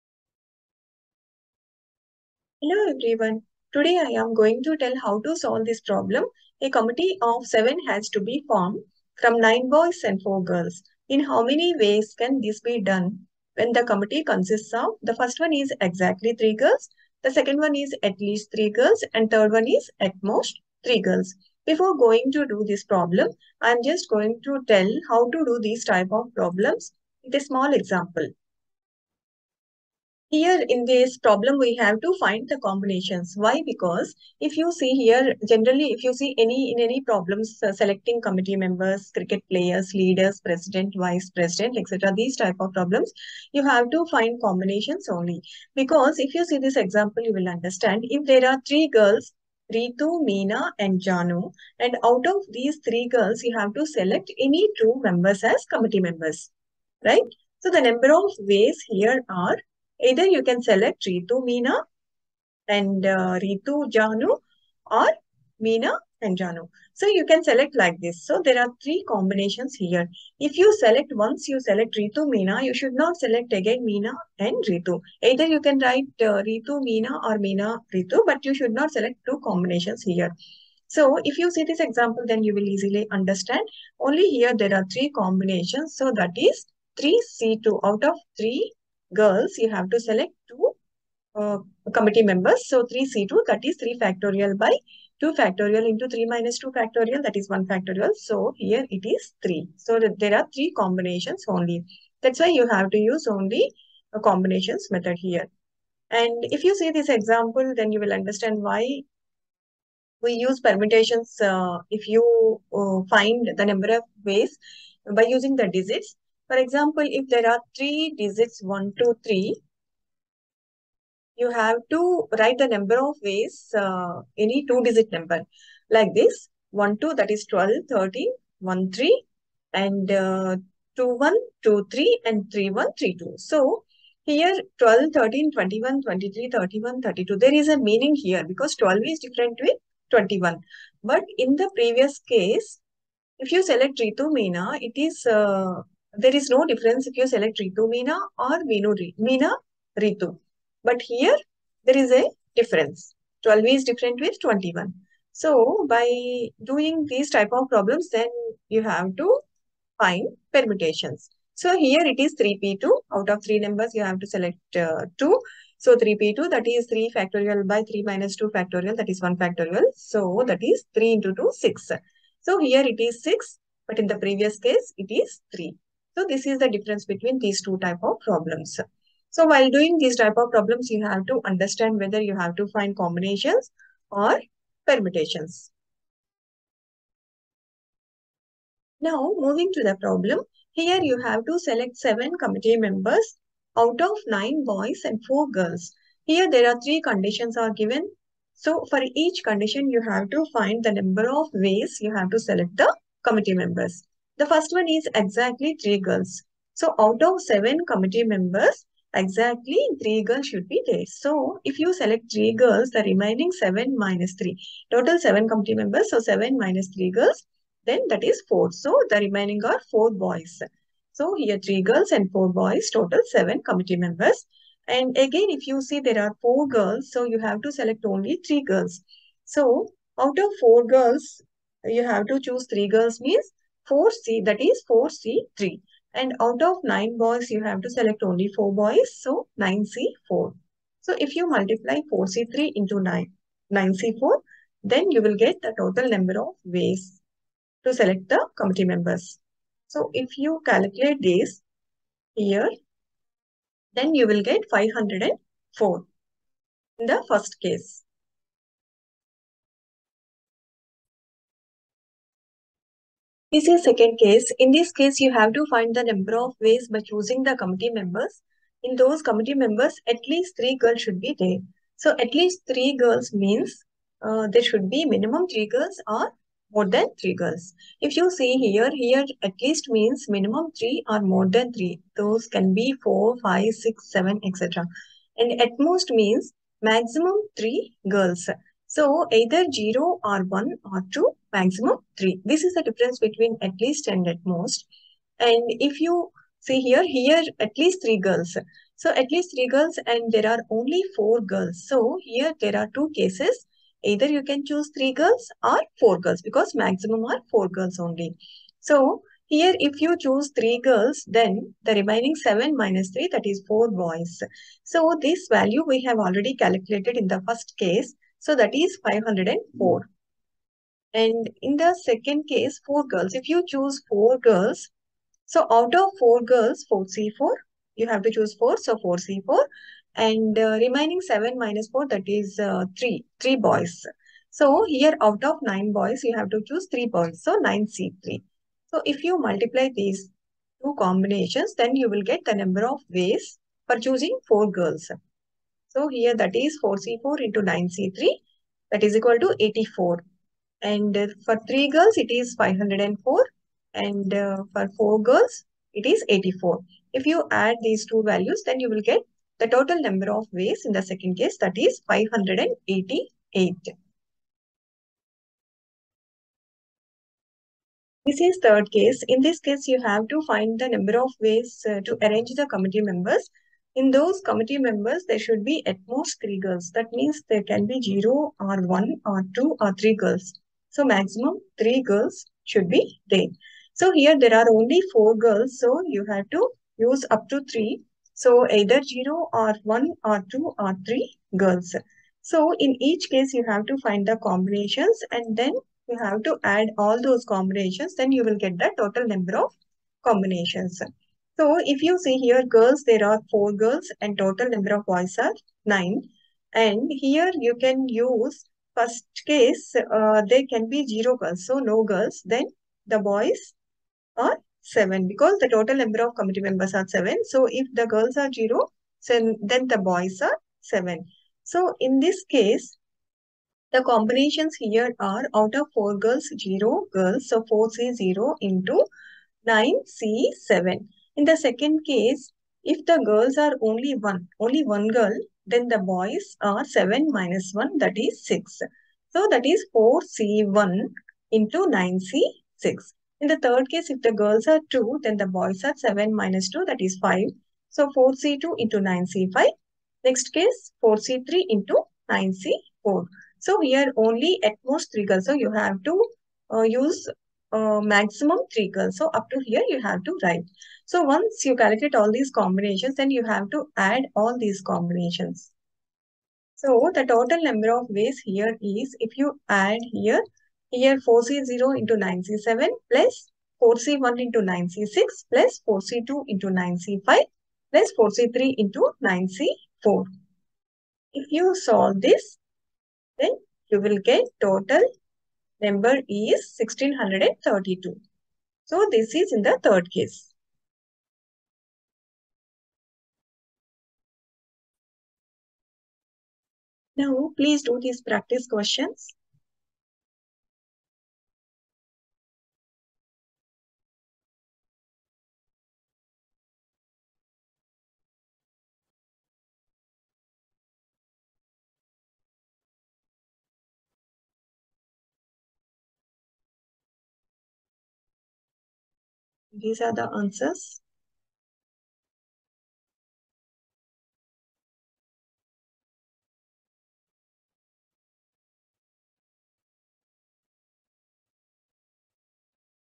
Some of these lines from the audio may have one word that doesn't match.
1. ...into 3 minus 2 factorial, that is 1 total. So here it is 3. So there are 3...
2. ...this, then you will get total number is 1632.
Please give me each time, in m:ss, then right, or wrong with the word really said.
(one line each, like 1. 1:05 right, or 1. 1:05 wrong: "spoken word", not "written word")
1. 1:35 wrong: "factorial", not "total"
2. 8:02 right.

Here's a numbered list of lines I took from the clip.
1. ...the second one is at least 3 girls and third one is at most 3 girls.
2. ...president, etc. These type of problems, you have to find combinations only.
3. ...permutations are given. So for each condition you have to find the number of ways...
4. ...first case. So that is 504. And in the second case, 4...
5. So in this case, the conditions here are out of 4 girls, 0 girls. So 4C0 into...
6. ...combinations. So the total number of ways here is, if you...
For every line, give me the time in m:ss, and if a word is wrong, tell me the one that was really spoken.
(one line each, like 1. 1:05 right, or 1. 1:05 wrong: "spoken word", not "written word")
1. 0:17 right
2. 0:41 right
3. 3:17 wrong: "conditions", not "permutations"
4. 5:17 right
5. 7:01 wrong: "combinations", not "conditions"
6. 7:44 right.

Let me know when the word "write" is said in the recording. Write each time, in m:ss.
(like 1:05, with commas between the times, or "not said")
1:15, 2:02, 7:40.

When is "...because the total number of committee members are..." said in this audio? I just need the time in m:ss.
6:55.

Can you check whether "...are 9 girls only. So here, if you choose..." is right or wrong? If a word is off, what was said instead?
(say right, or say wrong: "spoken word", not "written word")
wrong: "4", not "9".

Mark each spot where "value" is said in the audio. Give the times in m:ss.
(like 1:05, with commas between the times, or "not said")
5:15, 5:58.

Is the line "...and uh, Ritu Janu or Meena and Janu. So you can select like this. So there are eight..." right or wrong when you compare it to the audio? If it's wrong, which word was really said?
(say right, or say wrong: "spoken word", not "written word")
wrong: "three", not "eight".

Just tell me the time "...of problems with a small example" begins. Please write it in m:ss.
0:26.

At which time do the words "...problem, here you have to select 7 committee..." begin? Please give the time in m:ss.
3:10.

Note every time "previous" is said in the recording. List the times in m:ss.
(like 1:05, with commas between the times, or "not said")
2:21, 2:54.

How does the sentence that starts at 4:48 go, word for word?
So either 0 or 1 or 2, maximum 3.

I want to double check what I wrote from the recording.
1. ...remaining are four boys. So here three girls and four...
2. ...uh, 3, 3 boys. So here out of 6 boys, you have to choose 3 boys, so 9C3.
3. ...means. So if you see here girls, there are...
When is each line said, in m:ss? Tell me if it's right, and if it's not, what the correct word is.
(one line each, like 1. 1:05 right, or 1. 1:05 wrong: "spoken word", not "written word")
1. 3:39 right
2. 5:32 wrong: "9", not "6"
3. 6:40 wrong: "combinations", not "means".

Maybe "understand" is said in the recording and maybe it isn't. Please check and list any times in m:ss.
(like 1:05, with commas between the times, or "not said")
0:47, 1:23, 1:48, 3:01.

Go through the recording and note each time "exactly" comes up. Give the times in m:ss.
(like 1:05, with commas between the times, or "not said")
0:15, 3:25, 3:29.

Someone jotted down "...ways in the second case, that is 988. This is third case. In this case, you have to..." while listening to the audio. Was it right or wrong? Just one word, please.
wrong.